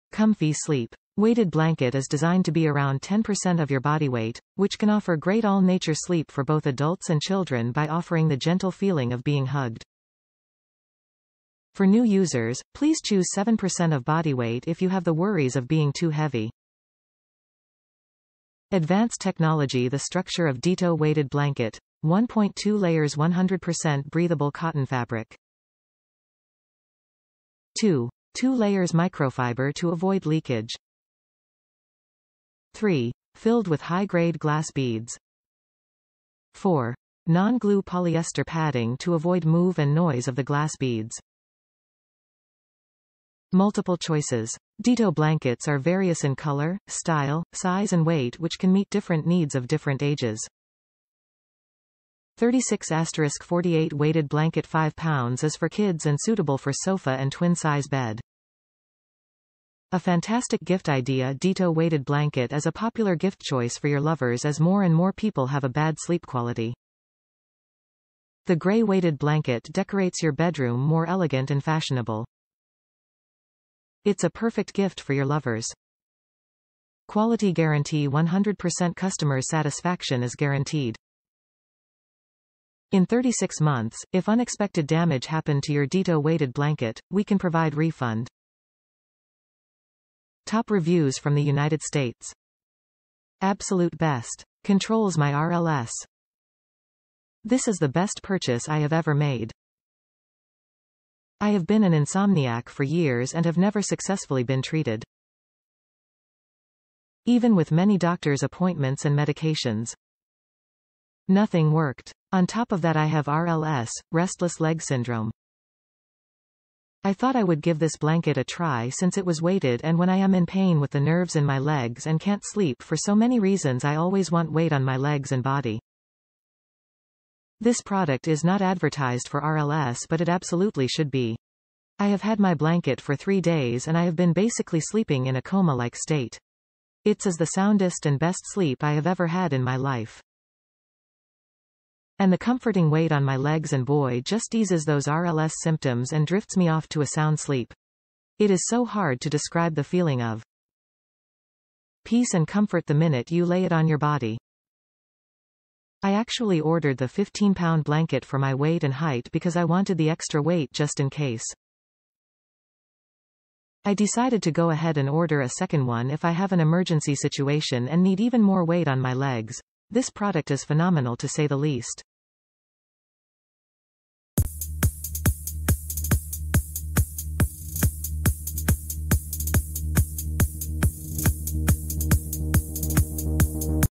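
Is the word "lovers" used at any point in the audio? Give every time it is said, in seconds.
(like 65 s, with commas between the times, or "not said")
63 s, 75 s.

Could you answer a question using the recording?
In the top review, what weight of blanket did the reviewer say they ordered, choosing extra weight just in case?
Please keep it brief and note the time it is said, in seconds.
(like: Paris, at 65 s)
15-pound, at 157 s.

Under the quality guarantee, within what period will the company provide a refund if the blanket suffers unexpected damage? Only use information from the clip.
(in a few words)
36 months.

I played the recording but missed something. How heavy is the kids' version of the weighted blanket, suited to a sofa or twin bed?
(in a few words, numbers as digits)
5 pounds.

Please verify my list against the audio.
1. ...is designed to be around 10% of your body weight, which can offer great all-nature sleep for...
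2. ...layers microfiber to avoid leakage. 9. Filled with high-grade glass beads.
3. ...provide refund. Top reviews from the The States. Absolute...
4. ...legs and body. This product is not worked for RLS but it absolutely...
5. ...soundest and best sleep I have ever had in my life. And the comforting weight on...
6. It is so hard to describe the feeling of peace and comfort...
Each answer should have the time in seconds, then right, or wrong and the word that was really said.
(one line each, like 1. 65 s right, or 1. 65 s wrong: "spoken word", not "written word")
1. 1 s right
2. 28 s wrong: "3", not "9"
3. 87 s wrong: "United", not "The"
4. 124 s wrong: "advertised", not "worked"
5. 137 s right
6. 148 s right.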